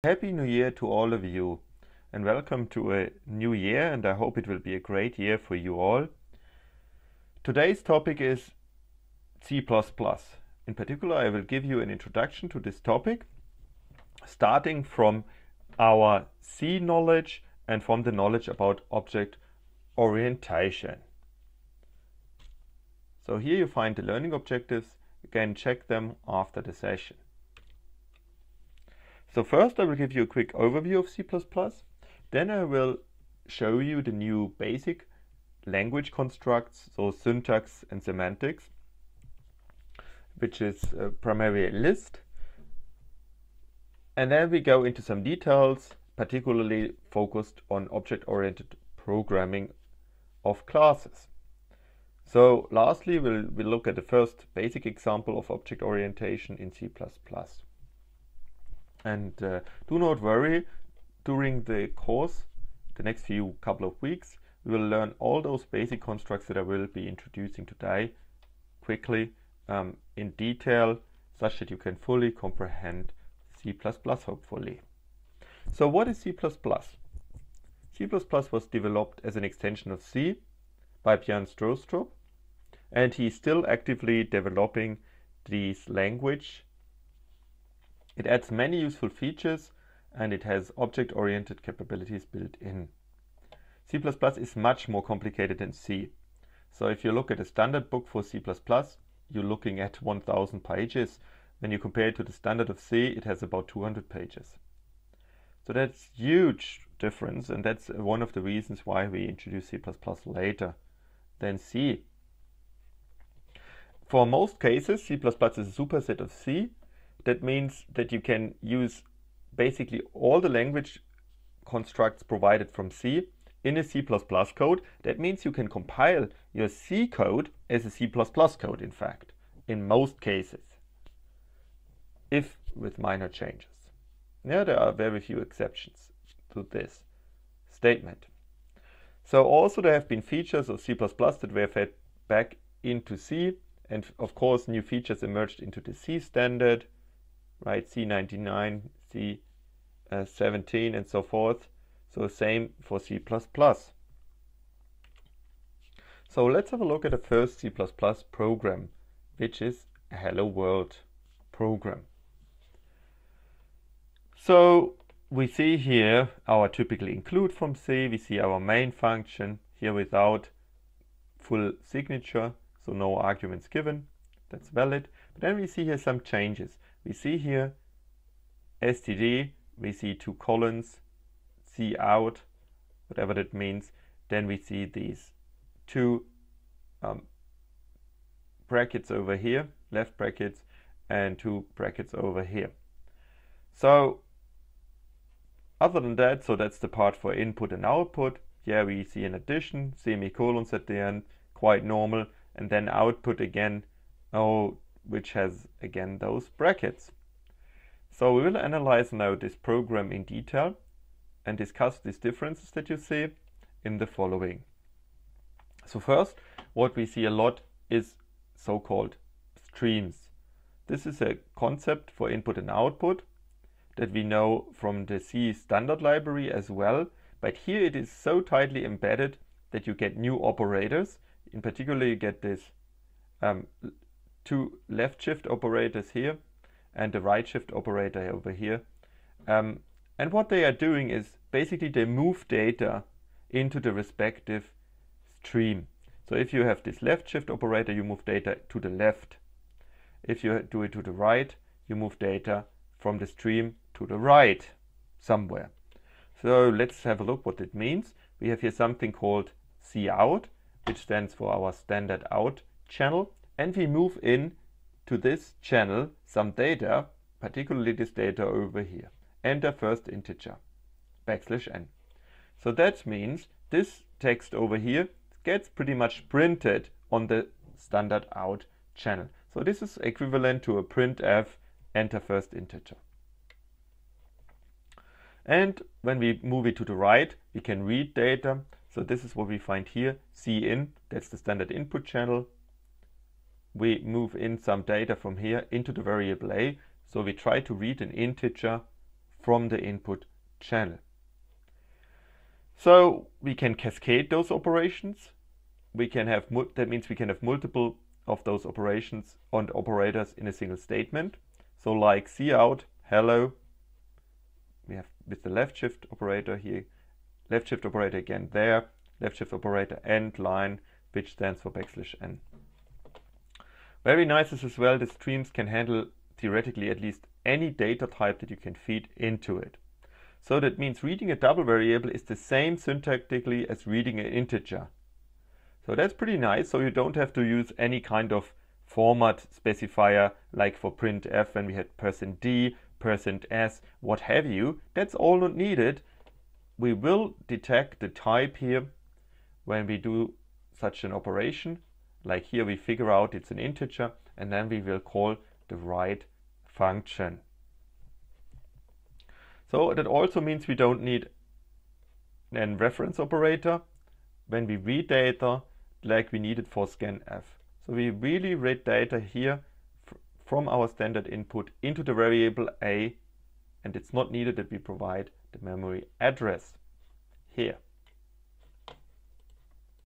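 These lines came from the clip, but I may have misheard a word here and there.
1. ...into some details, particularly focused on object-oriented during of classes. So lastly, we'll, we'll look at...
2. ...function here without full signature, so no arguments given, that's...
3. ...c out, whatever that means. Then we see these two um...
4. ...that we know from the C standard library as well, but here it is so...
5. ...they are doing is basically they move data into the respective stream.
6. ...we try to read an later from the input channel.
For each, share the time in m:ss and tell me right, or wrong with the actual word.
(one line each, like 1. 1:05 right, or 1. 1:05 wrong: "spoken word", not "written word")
1. 0:44 wrong: "programming", not "during"
2. 2:48 right
3. 3:01 right
4. 3:43 right
5. 4:00 right
6. 4:57 wrong: "integer", not "later".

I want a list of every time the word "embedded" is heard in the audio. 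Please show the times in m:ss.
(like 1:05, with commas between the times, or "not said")
3:48.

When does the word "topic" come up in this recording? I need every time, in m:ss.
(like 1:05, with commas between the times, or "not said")
0:07, 0:12.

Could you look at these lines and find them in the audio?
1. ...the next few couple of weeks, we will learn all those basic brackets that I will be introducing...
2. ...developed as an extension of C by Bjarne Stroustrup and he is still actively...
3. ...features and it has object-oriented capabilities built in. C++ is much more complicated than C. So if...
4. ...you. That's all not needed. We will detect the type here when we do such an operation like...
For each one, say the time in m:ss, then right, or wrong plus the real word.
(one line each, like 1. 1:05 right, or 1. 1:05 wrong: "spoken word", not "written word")
1. 1:02 wrong: "constructs", not "brackets"
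2. 1:18 right
3. 1:29 right
4. 5:44 right.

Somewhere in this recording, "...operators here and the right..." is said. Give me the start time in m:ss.
3:55.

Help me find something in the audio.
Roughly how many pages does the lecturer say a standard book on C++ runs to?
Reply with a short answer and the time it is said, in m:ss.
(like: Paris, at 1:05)
1000, at 1:40.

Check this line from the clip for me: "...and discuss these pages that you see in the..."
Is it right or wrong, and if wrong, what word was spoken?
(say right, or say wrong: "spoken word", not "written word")
wrong: "differences", not "pages".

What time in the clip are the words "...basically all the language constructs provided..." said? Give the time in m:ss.
1:59.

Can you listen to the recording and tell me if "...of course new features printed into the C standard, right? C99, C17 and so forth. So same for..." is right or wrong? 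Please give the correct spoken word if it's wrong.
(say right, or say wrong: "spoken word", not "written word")
wrong: "emerged", not "printed".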